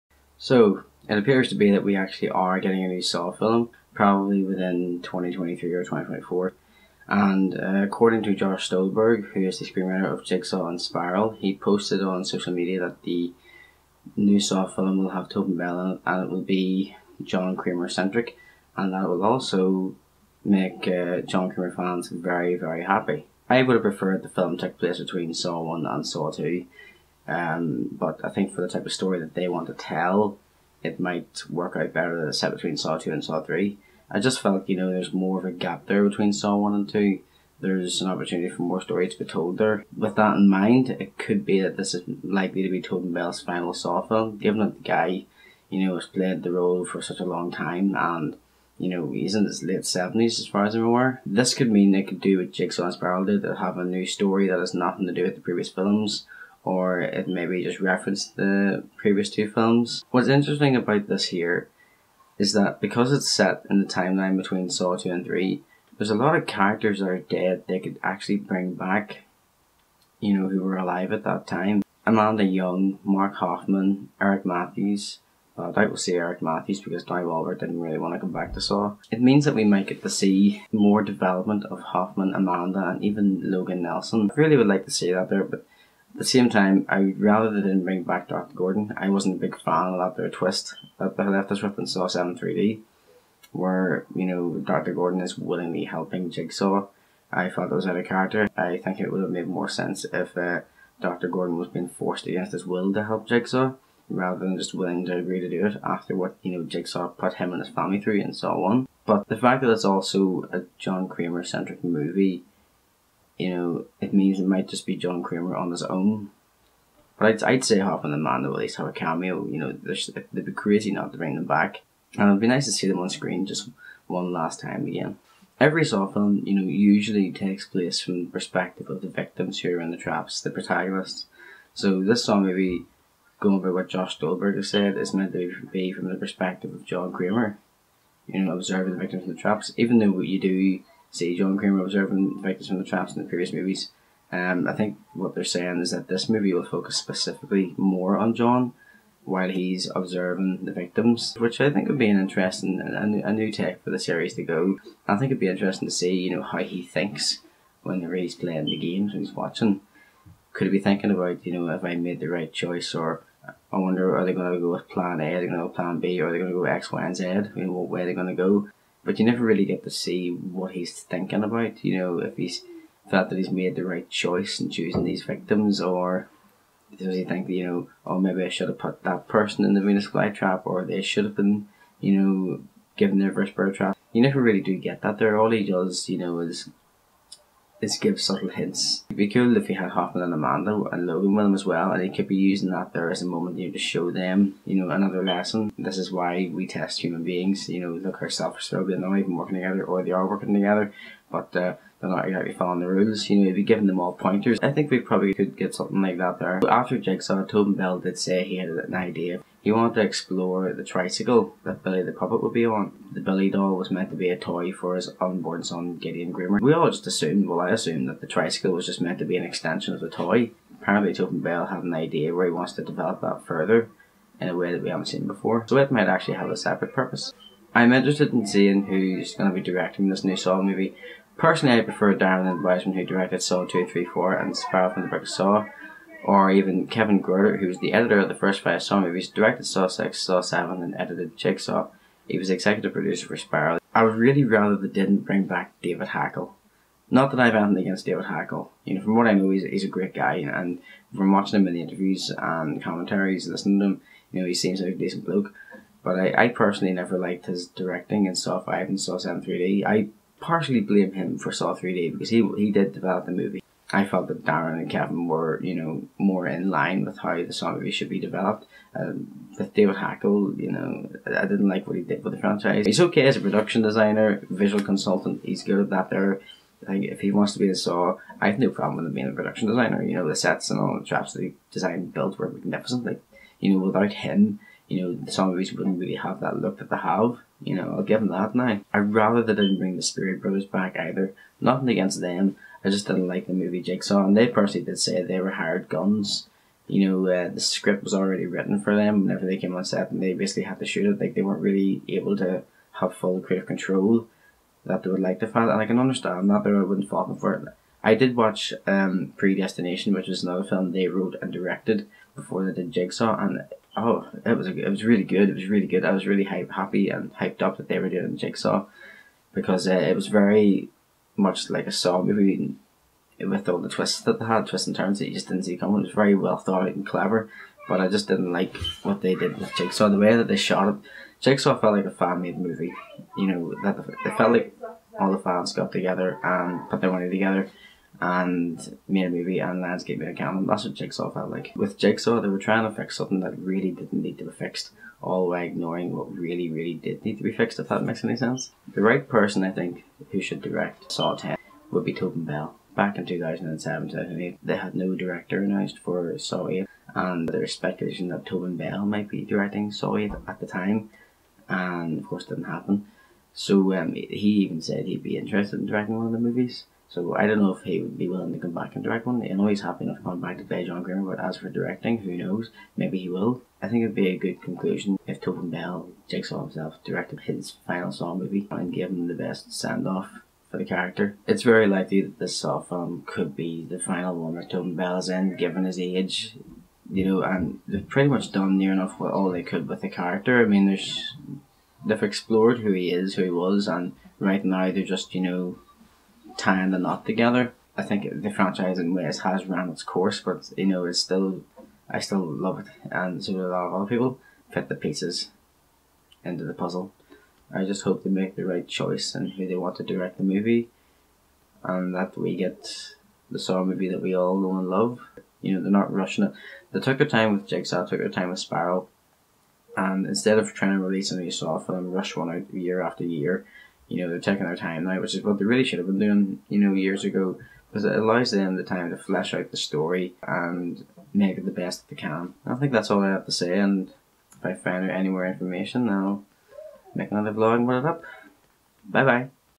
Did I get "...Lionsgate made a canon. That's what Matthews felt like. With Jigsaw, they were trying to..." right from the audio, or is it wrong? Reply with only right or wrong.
wrong.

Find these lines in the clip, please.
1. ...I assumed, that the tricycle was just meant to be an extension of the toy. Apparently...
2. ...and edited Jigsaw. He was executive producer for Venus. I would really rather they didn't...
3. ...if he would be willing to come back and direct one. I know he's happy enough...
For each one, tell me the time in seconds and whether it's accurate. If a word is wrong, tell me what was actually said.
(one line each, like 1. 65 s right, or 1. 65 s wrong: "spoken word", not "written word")
1. 217 s right
2. 240 s wrong: "Spiral", not "Venus"
3. 367 s right.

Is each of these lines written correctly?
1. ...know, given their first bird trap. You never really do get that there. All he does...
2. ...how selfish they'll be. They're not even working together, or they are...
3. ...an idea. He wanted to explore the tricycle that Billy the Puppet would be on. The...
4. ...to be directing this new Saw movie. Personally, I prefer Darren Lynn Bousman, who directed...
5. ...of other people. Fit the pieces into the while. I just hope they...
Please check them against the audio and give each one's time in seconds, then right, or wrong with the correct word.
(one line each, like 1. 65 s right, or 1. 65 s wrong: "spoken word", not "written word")
1. 182 s right
2. 198 s right
3. 208 s right
4. 229 s right
5. 403 s wrong: "puzzle", not "while".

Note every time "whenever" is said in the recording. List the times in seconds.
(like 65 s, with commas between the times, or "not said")
157 s, 299 s.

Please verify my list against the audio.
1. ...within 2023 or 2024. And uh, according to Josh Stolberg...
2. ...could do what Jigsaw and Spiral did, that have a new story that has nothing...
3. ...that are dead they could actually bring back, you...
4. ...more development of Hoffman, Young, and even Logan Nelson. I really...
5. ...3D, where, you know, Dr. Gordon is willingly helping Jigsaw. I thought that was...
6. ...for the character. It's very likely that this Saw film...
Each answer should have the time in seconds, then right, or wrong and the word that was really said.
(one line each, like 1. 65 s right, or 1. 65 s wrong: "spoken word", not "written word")
1. 4 s right
2. 52 s right
3. 66 s right
4. 80 s wrong: "Amanda", not "Young"
5. 92 s right
6. 380 s right.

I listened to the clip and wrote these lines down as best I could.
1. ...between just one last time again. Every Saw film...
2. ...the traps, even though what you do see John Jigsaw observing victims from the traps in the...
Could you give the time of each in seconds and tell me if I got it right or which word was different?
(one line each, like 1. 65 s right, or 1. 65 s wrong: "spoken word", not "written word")
1. 123 s wrong: "screen", not "between"
2. 139 s wrong: "Kramer", not "Jigsaw".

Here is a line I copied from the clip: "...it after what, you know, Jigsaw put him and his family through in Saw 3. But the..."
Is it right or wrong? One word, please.
wrong.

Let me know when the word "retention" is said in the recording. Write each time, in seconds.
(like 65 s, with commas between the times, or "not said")
not said.